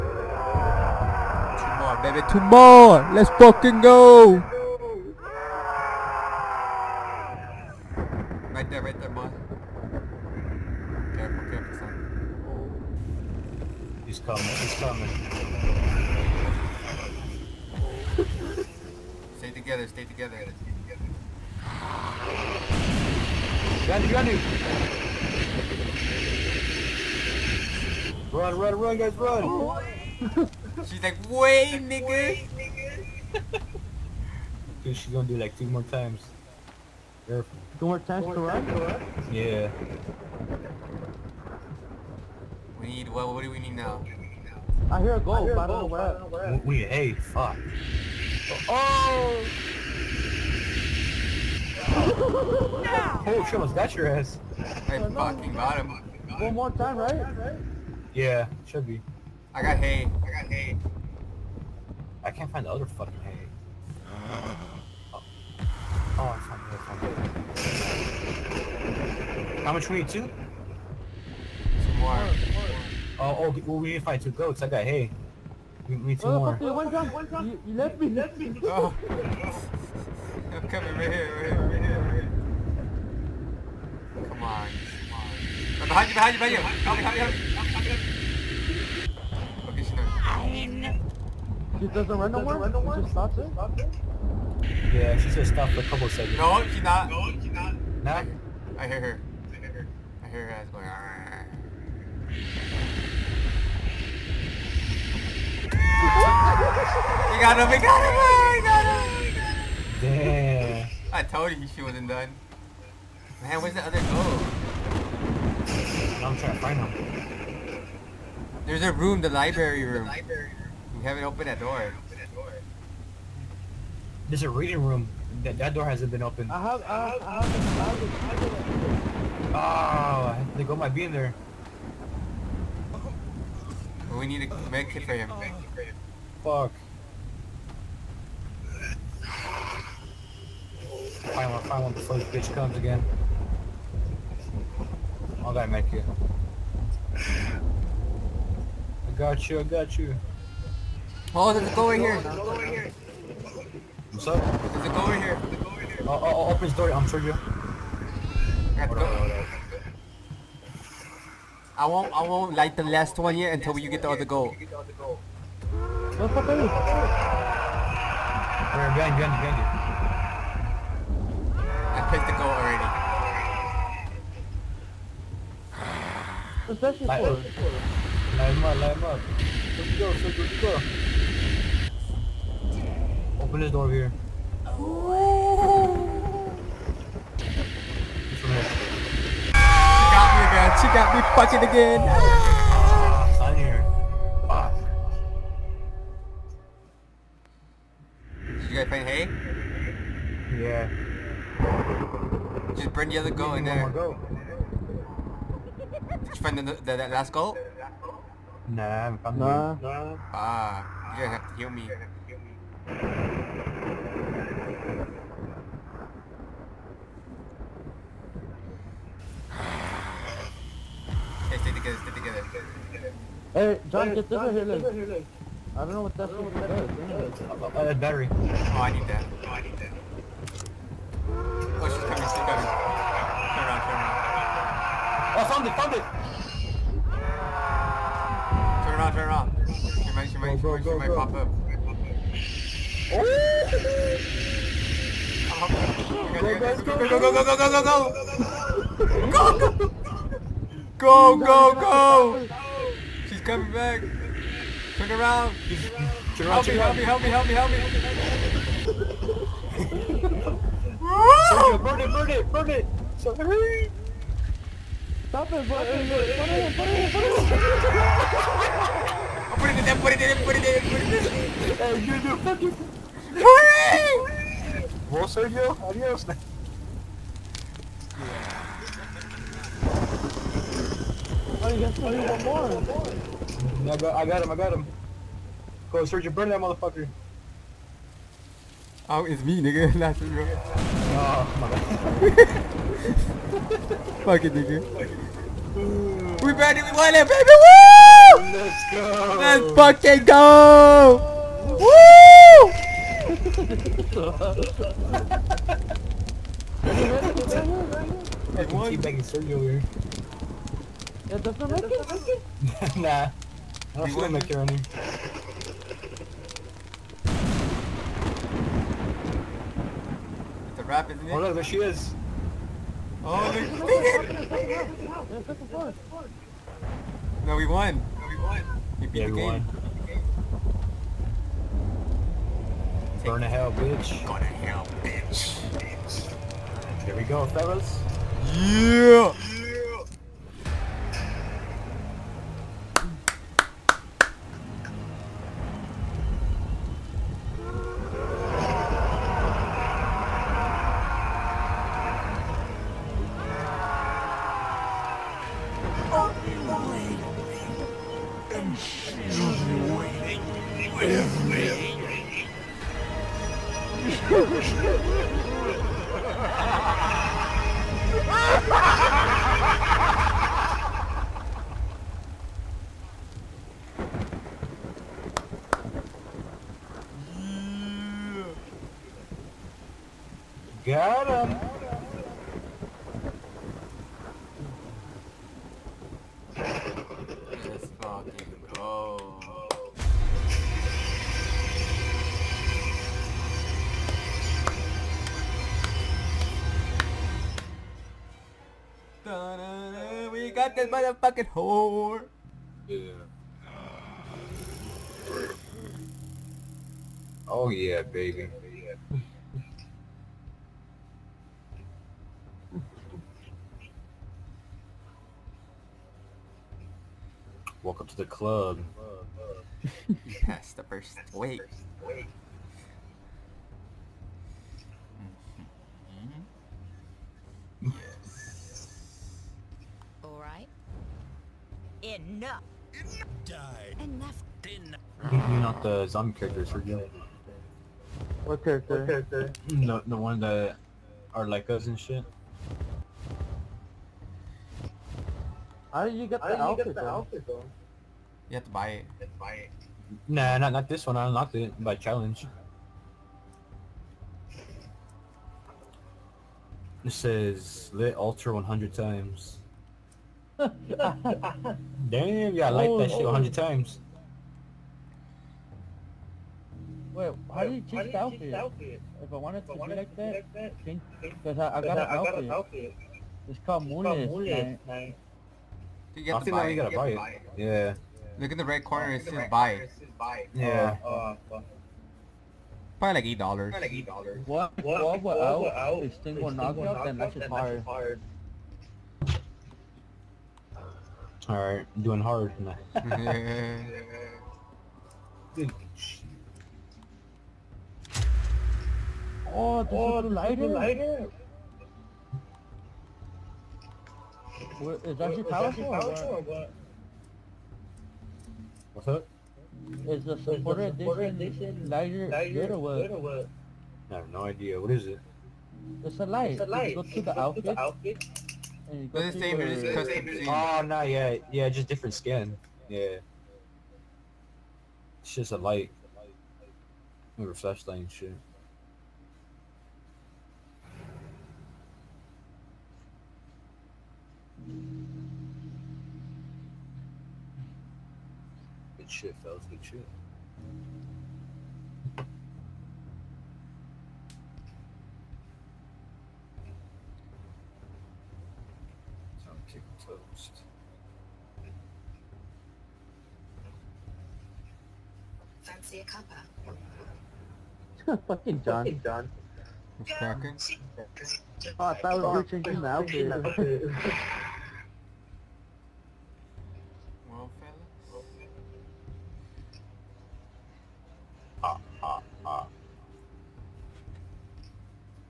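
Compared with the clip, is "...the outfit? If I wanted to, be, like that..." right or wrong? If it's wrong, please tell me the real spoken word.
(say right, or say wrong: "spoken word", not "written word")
right.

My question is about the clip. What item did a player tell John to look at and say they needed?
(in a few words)
battery.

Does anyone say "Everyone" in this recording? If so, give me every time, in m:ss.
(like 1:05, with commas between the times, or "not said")
5:08, 5:29.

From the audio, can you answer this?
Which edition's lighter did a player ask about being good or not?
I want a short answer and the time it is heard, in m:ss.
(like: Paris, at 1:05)
supporter edition, at 8:30.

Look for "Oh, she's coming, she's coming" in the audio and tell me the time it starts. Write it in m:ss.
3:51.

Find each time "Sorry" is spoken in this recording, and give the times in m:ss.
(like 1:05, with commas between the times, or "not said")
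4:23.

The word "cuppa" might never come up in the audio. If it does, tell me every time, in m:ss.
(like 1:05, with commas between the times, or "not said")
9:16.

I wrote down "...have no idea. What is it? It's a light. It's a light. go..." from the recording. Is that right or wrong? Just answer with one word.
right.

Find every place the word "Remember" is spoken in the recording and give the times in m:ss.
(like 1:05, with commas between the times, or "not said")
8:47.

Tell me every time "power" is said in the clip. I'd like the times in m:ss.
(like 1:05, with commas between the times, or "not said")
8:25.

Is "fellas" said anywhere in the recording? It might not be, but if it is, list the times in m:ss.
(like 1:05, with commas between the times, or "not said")
5:37, 8:59.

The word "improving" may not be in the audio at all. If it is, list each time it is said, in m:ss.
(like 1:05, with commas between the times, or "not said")
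not said.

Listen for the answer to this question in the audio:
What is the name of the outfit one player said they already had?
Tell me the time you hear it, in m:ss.
7:53.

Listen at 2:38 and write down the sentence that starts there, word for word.
I, won't, I won't light the last one yet until you get the other goal.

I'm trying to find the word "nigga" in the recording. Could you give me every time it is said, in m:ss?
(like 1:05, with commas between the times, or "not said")
0:31, 4:49, 4:54.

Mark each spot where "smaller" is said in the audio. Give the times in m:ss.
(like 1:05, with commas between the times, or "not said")
not said.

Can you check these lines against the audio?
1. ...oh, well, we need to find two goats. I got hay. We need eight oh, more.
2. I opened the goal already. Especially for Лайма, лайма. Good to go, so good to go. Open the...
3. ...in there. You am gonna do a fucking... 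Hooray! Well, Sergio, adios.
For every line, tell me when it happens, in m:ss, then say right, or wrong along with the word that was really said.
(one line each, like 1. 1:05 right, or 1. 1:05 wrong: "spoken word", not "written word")
1. 1:13 wrong: "two", not "eight"
2. 2:51 wrong: "picked", not "opened"
3. 4:31 right.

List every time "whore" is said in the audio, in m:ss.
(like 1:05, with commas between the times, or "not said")
6:41.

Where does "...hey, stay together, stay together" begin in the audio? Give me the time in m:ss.
3:41.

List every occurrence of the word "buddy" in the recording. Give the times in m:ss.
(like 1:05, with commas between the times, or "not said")
4:25.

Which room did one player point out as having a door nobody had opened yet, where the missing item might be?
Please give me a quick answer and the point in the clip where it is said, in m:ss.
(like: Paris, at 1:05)
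library room, at 1:59.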